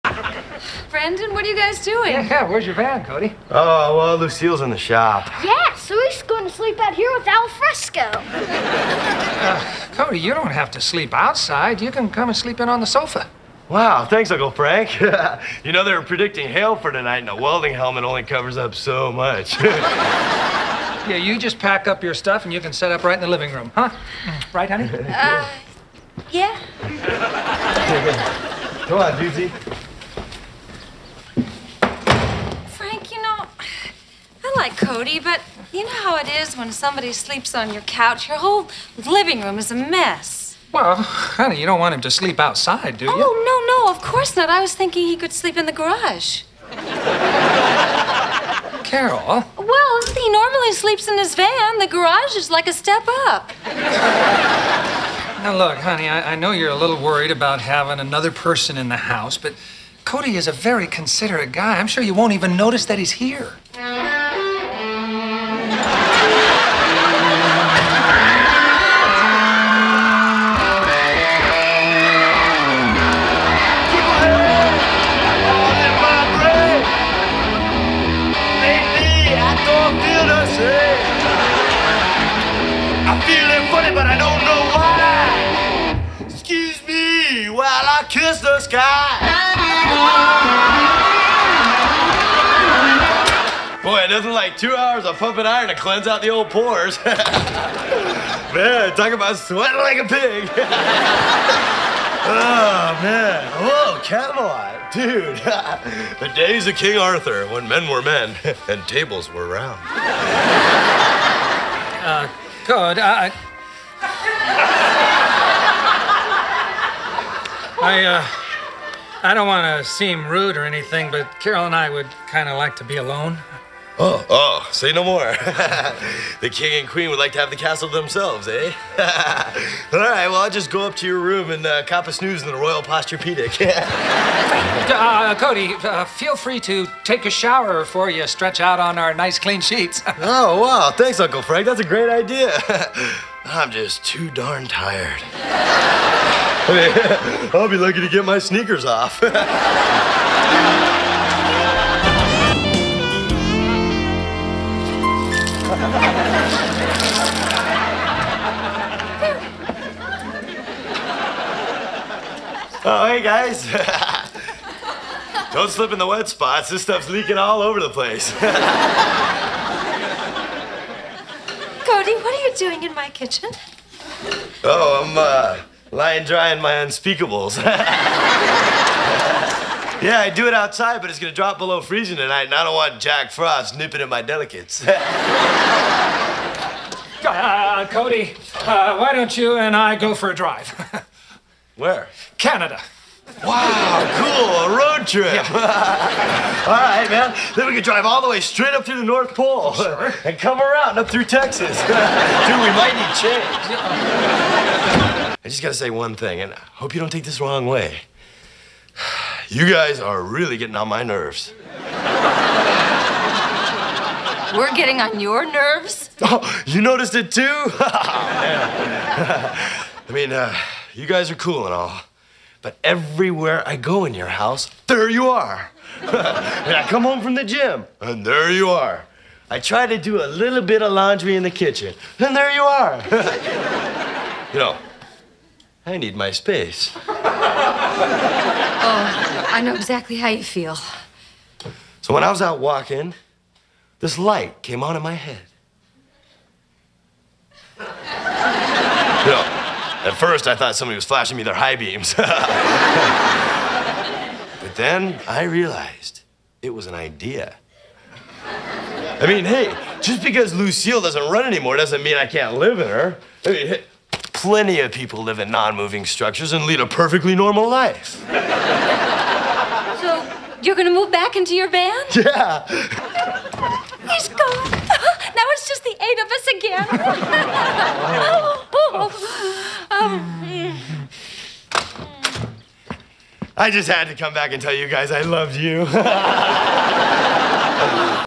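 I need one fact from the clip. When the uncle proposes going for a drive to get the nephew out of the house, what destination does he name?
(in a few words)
Canada.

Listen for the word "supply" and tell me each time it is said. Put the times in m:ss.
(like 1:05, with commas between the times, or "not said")
not said.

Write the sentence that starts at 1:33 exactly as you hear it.
Boy, it doesn't like two hours of pumping iron to cleanse out the old pores.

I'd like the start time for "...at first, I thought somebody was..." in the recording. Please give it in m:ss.
4:10.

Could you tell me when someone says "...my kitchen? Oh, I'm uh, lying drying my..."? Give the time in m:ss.
2:52.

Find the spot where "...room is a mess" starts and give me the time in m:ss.
0:39.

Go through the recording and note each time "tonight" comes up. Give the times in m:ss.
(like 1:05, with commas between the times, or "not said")
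0:16, 3:02.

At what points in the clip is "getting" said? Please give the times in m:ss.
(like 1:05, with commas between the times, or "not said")
3:30, 3:34.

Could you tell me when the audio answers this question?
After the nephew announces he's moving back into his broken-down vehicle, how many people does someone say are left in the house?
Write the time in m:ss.
4:35.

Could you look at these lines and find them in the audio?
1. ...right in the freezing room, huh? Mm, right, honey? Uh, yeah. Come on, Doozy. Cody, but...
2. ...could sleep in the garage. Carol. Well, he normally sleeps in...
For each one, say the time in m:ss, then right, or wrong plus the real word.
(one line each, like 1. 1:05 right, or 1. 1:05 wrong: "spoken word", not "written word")
1. 0:23 wrong: "living", not "freezing"
2. 0:45 right.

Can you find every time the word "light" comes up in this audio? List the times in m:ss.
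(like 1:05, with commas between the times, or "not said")
4:04.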